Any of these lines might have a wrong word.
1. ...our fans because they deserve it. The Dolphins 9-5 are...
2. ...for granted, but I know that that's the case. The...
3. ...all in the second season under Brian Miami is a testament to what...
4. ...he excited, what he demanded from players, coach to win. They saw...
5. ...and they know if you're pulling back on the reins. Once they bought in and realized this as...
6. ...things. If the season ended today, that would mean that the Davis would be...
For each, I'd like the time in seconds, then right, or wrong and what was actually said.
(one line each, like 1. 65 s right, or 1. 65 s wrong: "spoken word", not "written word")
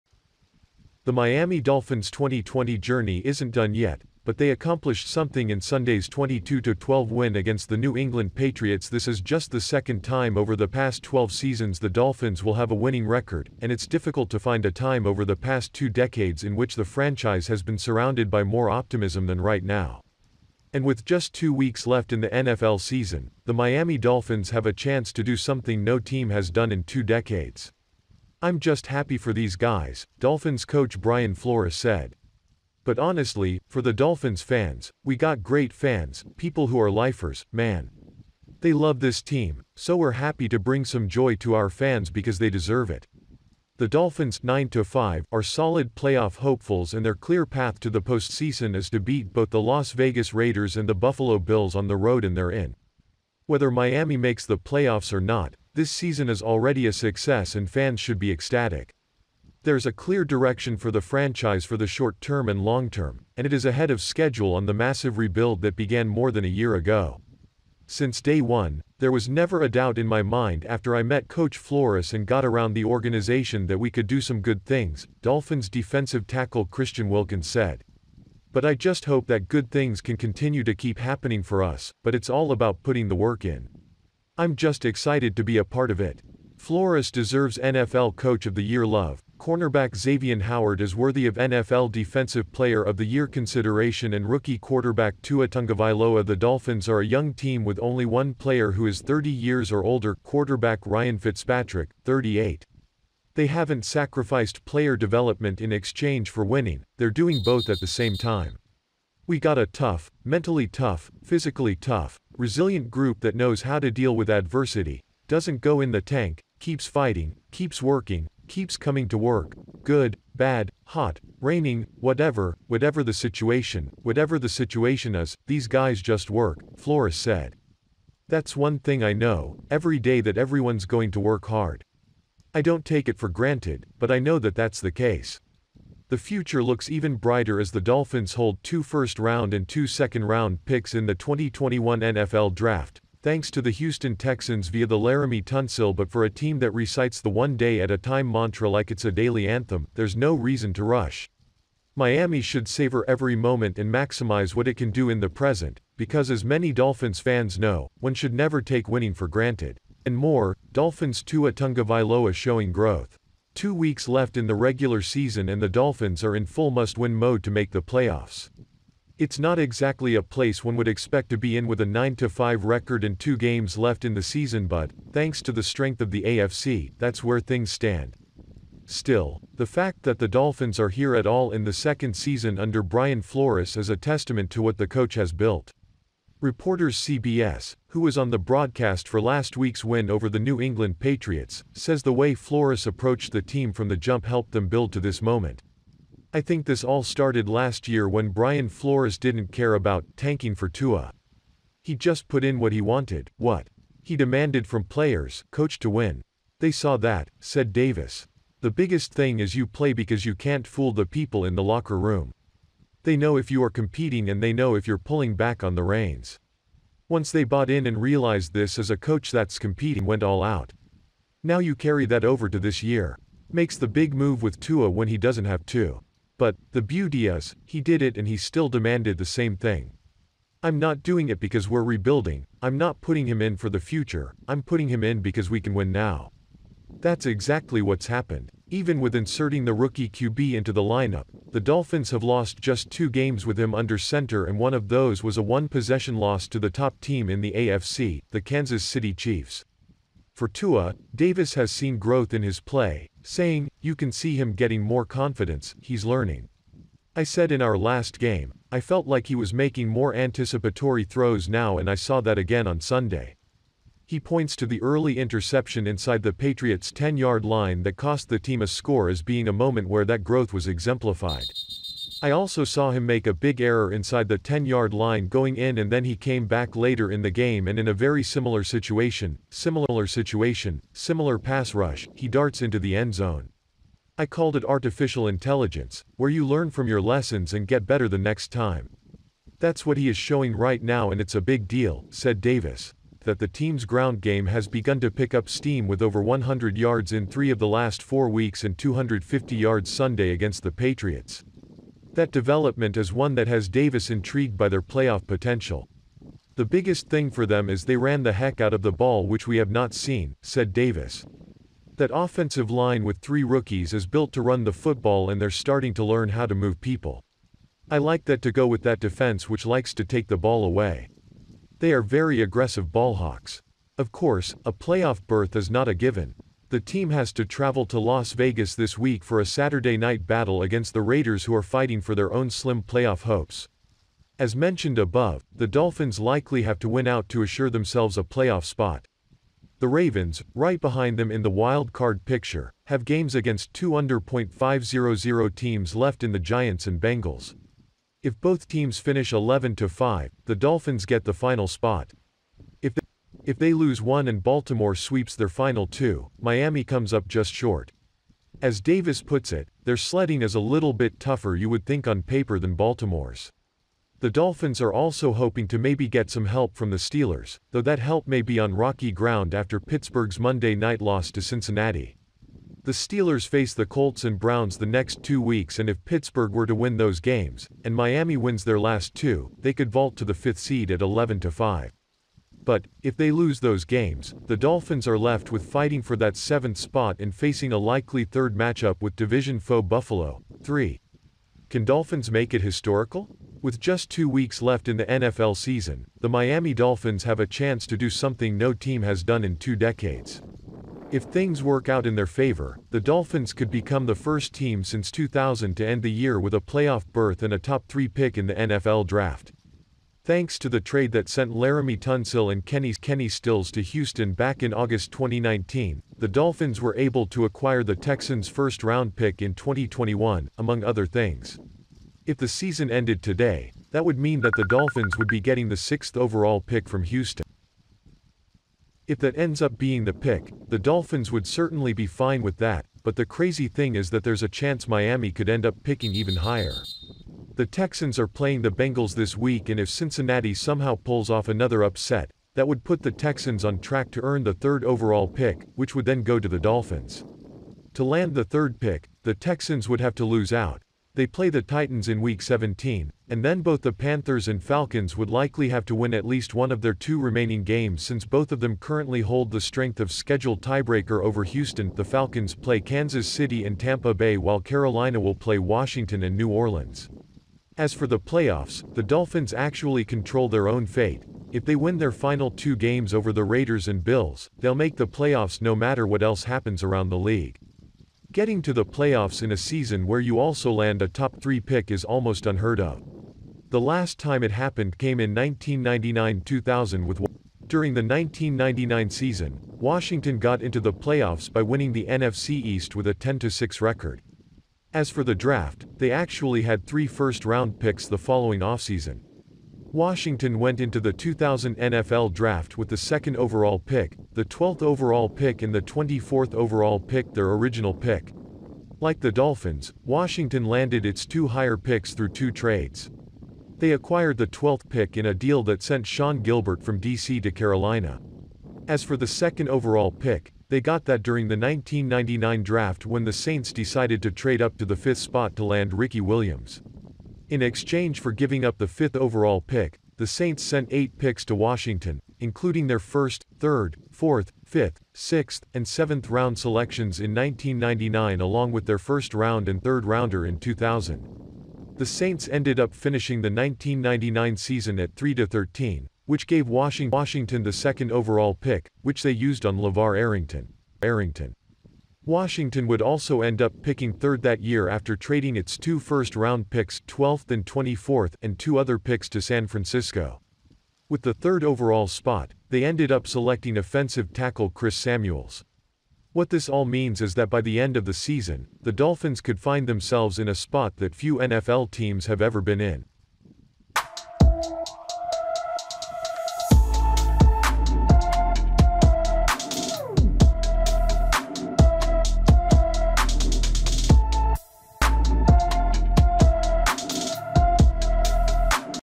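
1. 41 s right
2. 133 s right
3. 181 s wrong: "Flores", not "Miami"
4. 202 s wrong: "wanted", not "excited"
5. 214 s right
6. 421 s wrong: "Dolphins", not "Davis".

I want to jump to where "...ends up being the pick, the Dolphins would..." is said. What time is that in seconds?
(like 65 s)
429 s.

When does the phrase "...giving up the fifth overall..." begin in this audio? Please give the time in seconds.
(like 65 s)
528 s.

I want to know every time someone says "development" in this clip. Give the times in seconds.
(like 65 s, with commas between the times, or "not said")
104 s, 302 s.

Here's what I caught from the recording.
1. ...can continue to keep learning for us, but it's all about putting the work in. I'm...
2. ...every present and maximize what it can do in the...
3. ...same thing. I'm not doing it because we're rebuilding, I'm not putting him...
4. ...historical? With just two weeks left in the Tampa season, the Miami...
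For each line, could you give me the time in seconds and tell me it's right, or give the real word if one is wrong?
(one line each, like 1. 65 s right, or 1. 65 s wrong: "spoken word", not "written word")
1. 80 s wrong: "happening", not "learning"
2. 153 s wrong: "moment", not "present"
3. 229 s right
4. 392 s wrong: "NFL", not "Tampa".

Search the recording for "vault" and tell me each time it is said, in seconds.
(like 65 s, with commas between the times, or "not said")
379 s.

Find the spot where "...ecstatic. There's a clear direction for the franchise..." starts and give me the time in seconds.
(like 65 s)
58 s.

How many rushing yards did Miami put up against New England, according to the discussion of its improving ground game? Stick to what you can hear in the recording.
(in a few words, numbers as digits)
250 yards.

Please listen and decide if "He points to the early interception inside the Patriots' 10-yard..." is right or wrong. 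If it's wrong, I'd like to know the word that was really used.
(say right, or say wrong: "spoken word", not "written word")
right.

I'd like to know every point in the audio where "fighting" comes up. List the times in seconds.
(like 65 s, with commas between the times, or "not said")
116 s, 331 s, 385 s.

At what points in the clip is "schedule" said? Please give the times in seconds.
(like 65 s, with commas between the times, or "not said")
64 s, 460 s.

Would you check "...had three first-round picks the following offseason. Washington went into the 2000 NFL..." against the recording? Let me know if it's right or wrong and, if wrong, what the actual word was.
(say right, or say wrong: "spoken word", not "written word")
right.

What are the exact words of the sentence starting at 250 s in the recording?
For Tua, Davis has seen growth in his play, saying, You can see him getting more confidence, he's learning.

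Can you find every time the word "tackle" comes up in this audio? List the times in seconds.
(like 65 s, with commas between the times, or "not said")
76 s, 564 s.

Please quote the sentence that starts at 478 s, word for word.
Getting to the playoffs in a season where you also land a top 3 pick is almost unheard of.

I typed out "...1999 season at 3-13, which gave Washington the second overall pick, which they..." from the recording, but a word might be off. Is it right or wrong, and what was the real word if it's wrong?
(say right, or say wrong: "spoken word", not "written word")
right.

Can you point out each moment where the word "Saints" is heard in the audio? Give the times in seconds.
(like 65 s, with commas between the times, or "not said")
523 s, 530 s, 542 s.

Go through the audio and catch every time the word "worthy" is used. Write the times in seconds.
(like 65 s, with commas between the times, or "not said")
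90 s.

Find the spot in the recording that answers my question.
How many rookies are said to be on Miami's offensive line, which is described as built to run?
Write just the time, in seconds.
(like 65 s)
313 s.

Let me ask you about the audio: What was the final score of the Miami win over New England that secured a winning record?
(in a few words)
22-12.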